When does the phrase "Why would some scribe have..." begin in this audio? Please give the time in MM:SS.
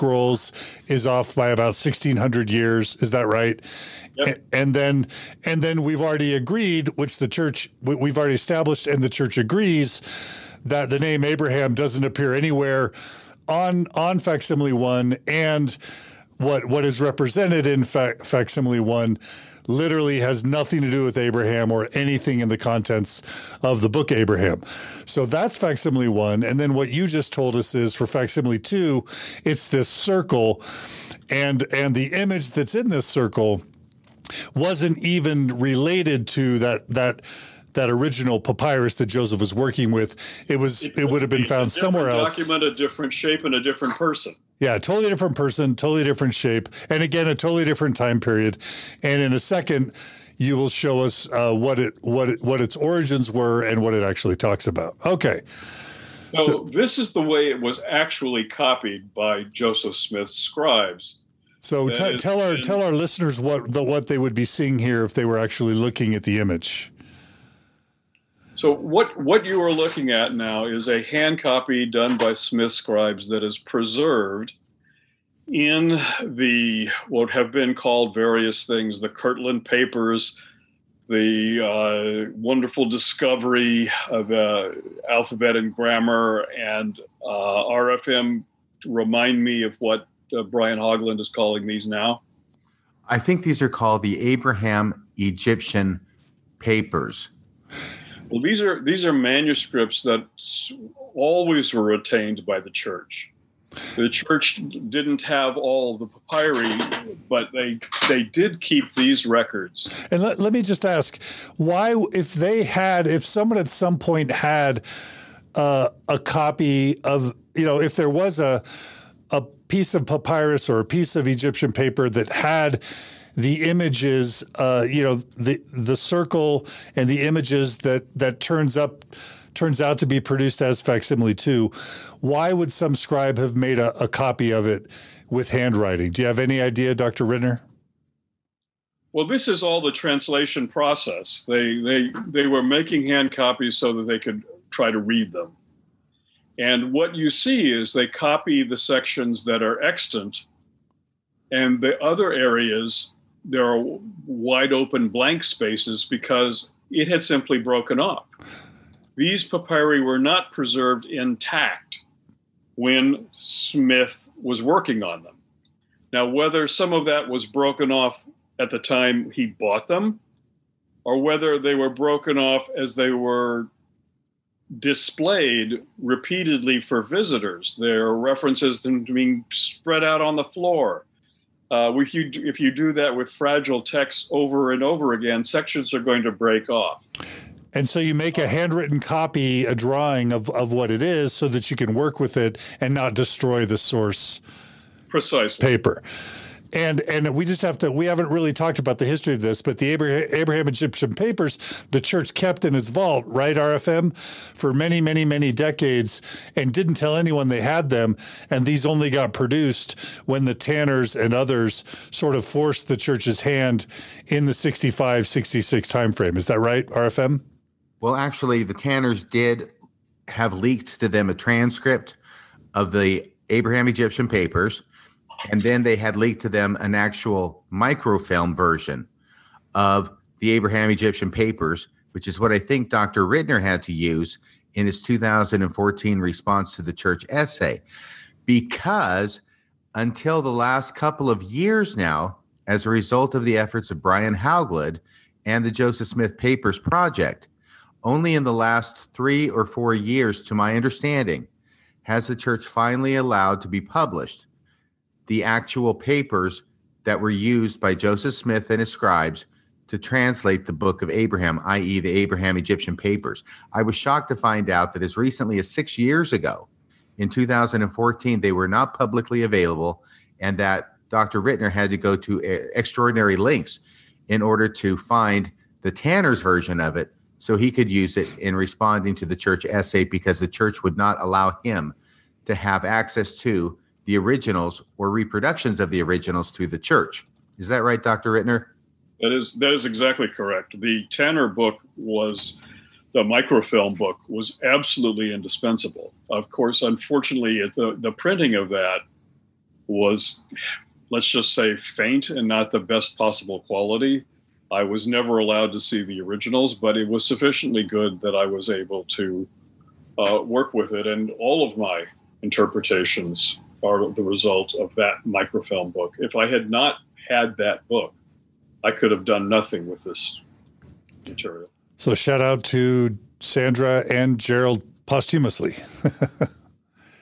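02:12.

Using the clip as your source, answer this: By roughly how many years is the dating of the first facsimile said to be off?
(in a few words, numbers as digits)
1600 years.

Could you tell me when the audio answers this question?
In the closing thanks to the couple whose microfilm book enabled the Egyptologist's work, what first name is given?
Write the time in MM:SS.
05:23.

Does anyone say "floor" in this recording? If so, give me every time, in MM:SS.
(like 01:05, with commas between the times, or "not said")
03:00.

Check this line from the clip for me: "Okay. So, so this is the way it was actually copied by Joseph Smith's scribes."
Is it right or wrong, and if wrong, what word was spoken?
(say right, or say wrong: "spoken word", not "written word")
right.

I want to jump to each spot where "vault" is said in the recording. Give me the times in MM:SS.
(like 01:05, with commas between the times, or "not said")
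03:22.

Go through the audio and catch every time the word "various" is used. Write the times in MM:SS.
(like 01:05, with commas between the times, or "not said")
01:18.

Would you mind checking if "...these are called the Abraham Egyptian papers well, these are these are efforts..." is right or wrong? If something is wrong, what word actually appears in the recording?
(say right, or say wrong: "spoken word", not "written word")
wrong: "manuscripts", not "efforts".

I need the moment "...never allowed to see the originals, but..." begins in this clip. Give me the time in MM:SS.
05:05.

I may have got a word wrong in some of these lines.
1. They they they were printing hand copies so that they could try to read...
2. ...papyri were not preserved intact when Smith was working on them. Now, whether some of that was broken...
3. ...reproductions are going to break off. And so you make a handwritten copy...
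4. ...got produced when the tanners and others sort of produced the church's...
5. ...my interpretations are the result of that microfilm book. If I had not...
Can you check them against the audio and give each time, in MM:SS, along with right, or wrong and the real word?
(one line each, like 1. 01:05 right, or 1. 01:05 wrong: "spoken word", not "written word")
1. 02:21 wrong: "making", not "printing"
2. 02:39 right
3. 03:05 wrong: "sections", not "reproductions"
4. 03:29 wrong: "forced", not "produced"
5. 05:11 right.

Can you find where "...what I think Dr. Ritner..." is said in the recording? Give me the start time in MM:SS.
03:52.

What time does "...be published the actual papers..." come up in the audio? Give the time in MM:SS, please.
04:13.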